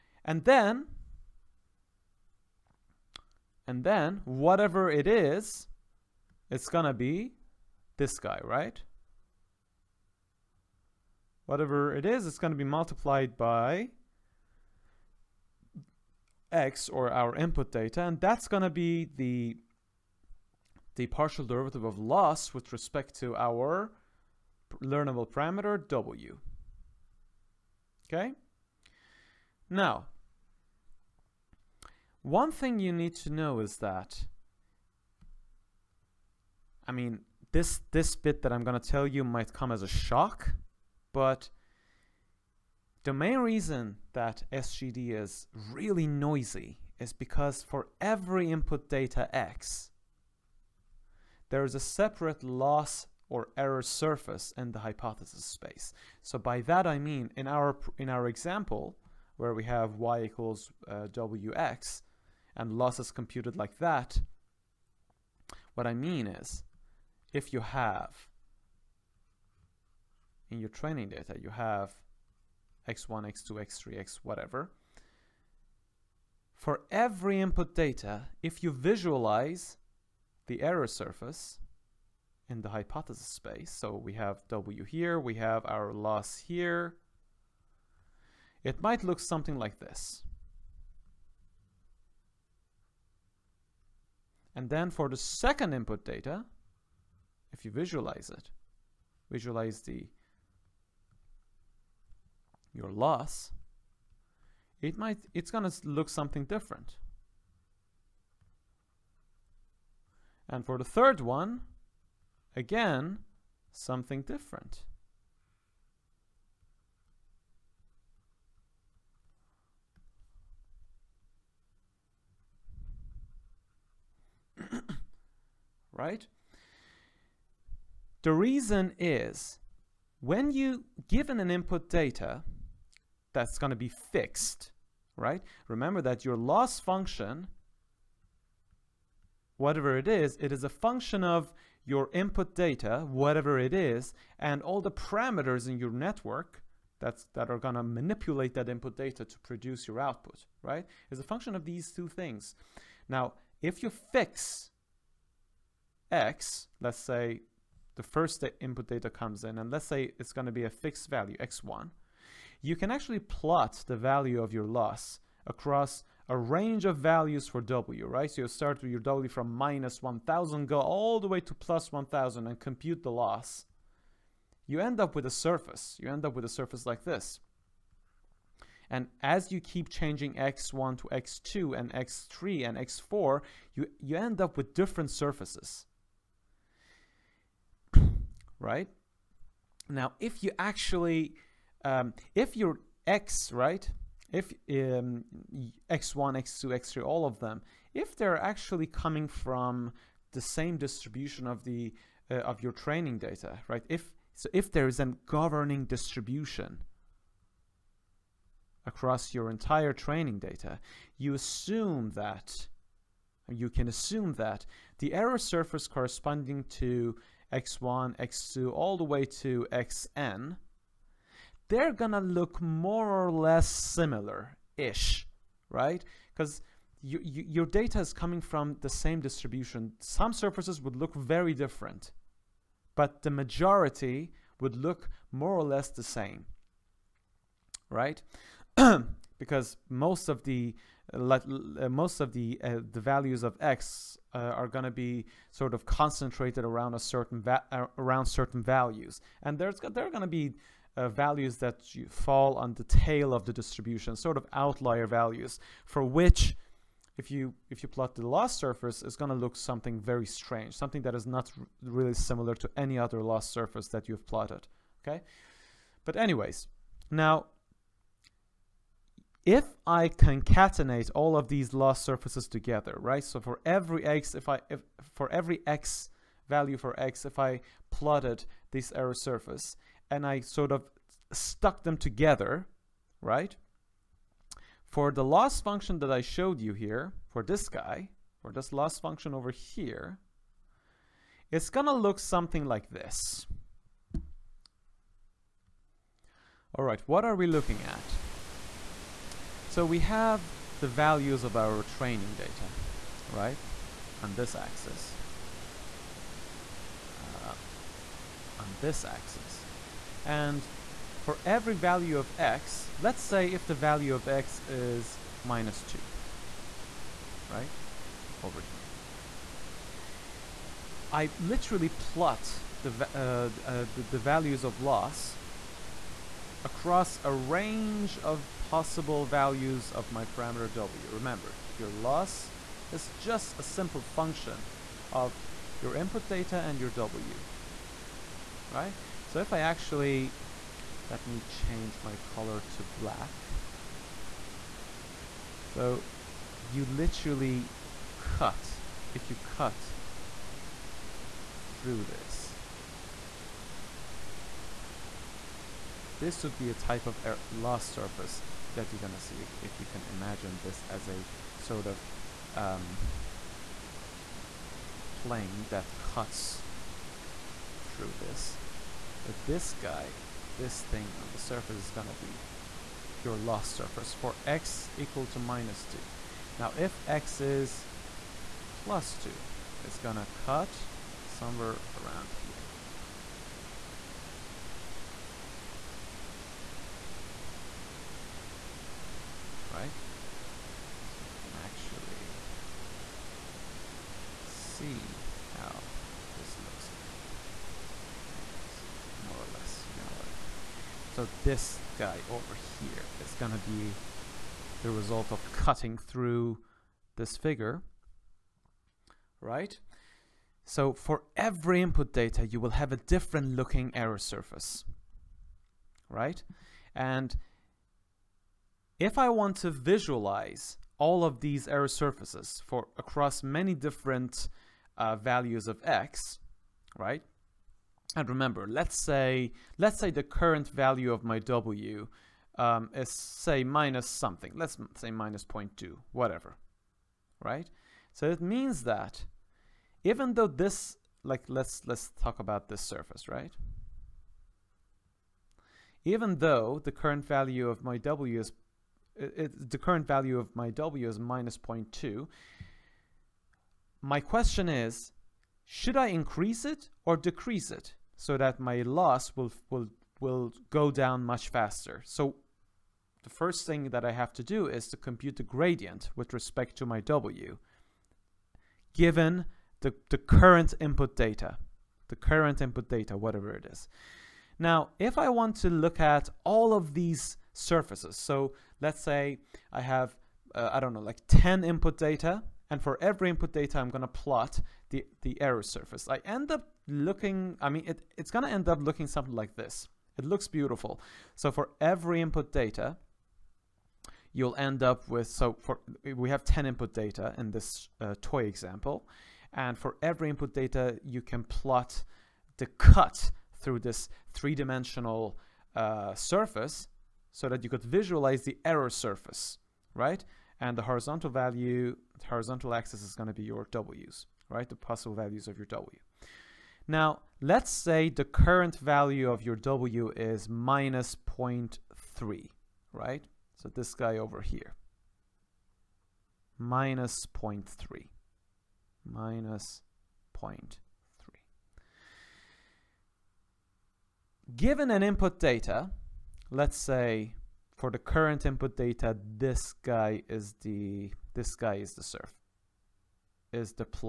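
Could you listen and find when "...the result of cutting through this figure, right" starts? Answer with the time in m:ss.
6:44.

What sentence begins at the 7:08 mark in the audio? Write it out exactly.
and remember, let's say, let's say the current value of my W um, is say minus something.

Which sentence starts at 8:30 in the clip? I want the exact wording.
And the horizontal value, the horizontal axis is going to be your W's, right?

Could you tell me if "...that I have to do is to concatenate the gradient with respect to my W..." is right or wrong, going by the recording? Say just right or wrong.
wrong.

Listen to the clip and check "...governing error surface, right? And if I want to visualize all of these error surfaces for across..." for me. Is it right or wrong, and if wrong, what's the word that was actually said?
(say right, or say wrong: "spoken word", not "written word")
wrong: "looking", not "governing".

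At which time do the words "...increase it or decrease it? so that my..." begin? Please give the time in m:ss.
7:36.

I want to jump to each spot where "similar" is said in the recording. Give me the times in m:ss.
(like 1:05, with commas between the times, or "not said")
3:43, 4:22.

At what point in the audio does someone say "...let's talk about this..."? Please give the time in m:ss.
7:21.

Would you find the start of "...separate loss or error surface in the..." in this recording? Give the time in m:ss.
0:51.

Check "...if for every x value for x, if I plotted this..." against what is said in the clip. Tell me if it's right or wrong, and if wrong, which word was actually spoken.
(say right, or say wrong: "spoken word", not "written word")
right.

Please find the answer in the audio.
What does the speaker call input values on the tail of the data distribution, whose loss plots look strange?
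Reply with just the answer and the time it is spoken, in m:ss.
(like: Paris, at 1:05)
outlier values, at 4:14.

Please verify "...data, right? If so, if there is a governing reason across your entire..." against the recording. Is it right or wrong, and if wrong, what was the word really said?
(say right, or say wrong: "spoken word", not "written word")
wrong: "distribution", not "reason".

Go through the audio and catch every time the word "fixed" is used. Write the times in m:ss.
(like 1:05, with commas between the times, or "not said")
2:13, 2:40.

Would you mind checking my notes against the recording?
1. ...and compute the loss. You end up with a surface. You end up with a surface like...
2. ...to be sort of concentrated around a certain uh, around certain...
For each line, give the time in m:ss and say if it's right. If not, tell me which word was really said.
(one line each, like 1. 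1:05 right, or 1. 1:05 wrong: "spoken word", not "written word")
1. 2:52 right
2. 4:04 right.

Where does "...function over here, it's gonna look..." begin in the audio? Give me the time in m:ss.
4:48.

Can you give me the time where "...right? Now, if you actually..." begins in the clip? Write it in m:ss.
3:08.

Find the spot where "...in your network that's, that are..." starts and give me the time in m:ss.
2:25.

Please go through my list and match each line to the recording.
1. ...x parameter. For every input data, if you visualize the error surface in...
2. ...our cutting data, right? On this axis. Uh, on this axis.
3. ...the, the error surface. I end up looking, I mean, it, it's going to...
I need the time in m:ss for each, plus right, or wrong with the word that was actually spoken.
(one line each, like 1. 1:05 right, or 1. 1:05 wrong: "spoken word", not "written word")
1. 1:13 wrong: "whatever", not "parameter"
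2. 5:01 wrong: "training", not "cutting"
3. 8:04 right.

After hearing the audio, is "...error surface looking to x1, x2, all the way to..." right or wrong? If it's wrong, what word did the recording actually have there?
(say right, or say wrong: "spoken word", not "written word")
wrong: "corresponding", not "looking".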